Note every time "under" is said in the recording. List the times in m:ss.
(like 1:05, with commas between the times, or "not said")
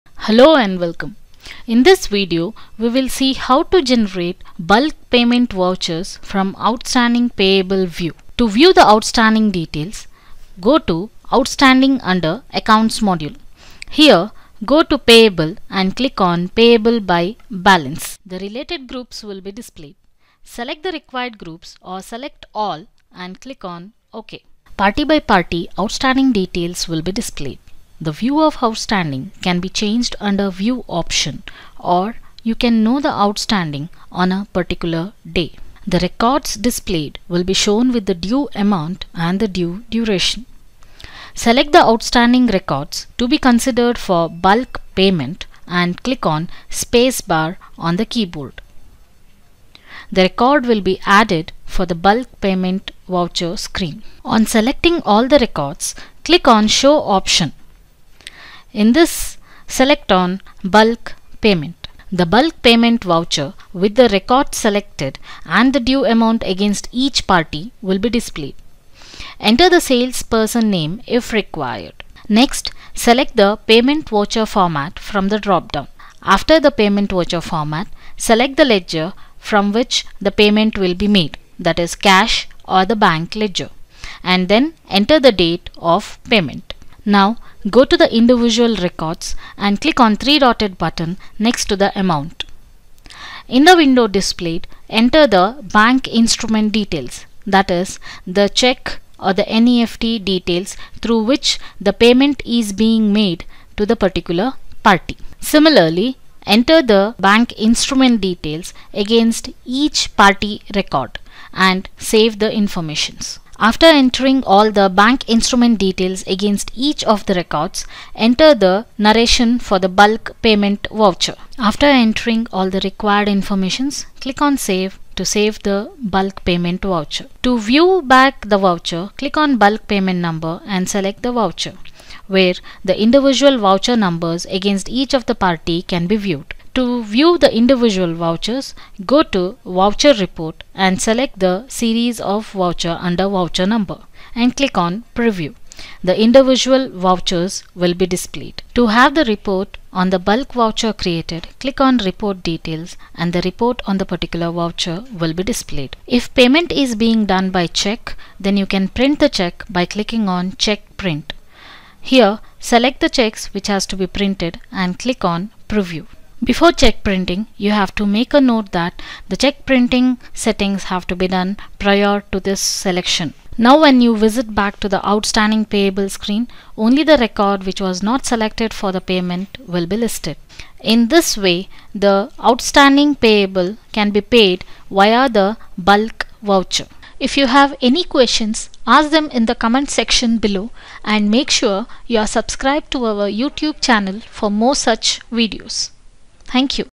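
0:12, 0:30, 2:23.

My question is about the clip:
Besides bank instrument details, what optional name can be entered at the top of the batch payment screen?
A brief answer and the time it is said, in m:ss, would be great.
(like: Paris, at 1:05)
Salesperson name, at 1:09.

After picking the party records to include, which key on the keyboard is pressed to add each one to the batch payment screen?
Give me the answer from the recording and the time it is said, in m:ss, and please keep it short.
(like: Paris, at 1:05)
Spacebar, at 0:46.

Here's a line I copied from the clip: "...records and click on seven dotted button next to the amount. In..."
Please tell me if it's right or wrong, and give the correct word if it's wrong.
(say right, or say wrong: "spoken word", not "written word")
wrong: "three", not "seven".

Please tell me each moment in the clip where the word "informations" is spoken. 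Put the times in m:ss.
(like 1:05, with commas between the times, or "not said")
1:52, 2:03.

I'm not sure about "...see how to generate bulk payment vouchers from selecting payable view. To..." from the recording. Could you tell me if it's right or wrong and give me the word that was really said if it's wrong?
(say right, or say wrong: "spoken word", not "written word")
wrong: "outstanding", not "selecting".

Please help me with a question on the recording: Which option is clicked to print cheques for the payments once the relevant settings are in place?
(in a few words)
Check Print.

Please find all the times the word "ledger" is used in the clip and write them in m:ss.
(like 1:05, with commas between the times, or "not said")
1:18, 1:23.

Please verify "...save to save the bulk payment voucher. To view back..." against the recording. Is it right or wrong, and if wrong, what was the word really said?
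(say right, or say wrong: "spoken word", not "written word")
right.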